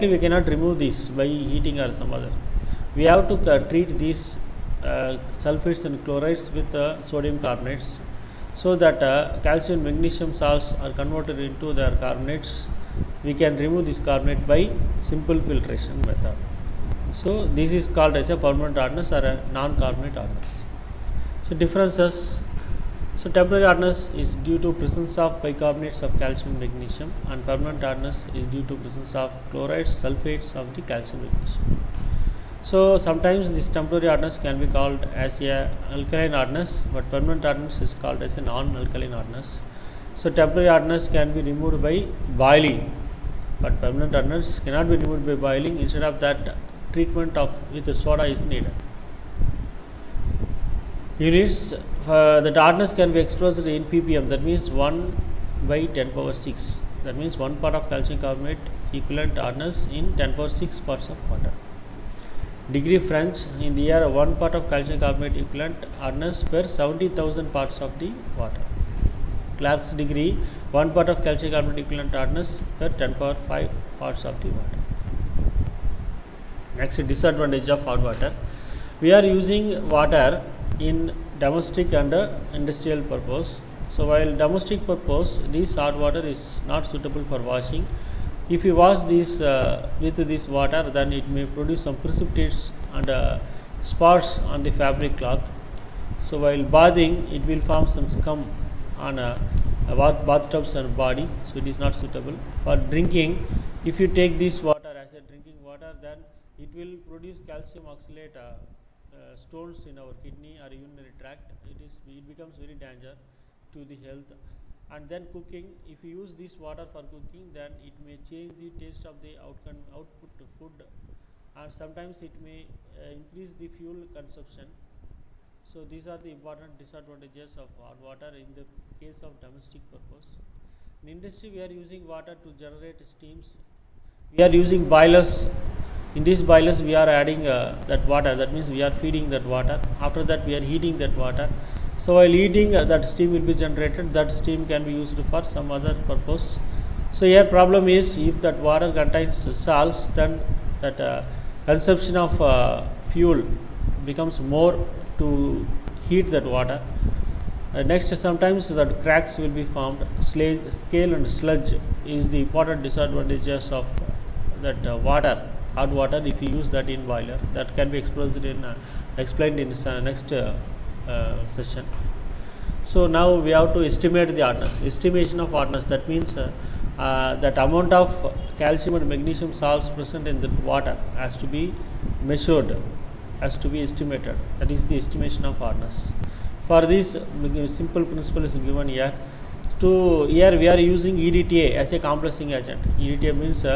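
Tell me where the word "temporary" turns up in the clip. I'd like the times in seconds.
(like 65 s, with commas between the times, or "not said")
23 s, 33 s, 40 s.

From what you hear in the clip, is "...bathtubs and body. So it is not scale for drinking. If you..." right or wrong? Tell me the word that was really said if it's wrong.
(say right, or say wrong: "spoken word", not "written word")
wrong: "suitable", not "scale".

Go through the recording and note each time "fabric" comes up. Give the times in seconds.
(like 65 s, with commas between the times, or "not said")
94 s.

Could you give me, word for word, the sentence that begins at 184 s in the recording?
That is the estimation of hardness.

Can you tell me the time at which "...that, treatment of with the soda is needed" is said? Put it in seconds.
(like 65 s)
46 s.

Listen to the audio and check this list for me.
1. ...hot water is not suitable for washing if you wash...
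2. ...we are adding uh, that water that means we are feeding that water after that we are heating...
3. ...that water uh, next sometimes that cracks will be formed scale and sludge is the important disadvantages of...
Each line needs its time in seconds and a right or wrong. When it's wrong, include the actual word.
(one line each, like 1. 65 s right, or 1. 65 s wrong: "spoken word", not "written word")
1. 85 s right
2. 136 s right
3. 156 s right.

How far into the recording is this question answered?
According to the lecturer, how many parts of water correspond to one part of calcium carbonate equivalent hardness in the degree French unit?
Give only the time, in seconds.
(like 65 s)
66 s.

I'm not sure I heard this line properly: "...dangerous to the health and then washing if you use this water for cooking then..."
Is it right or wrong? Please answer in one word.
wrong.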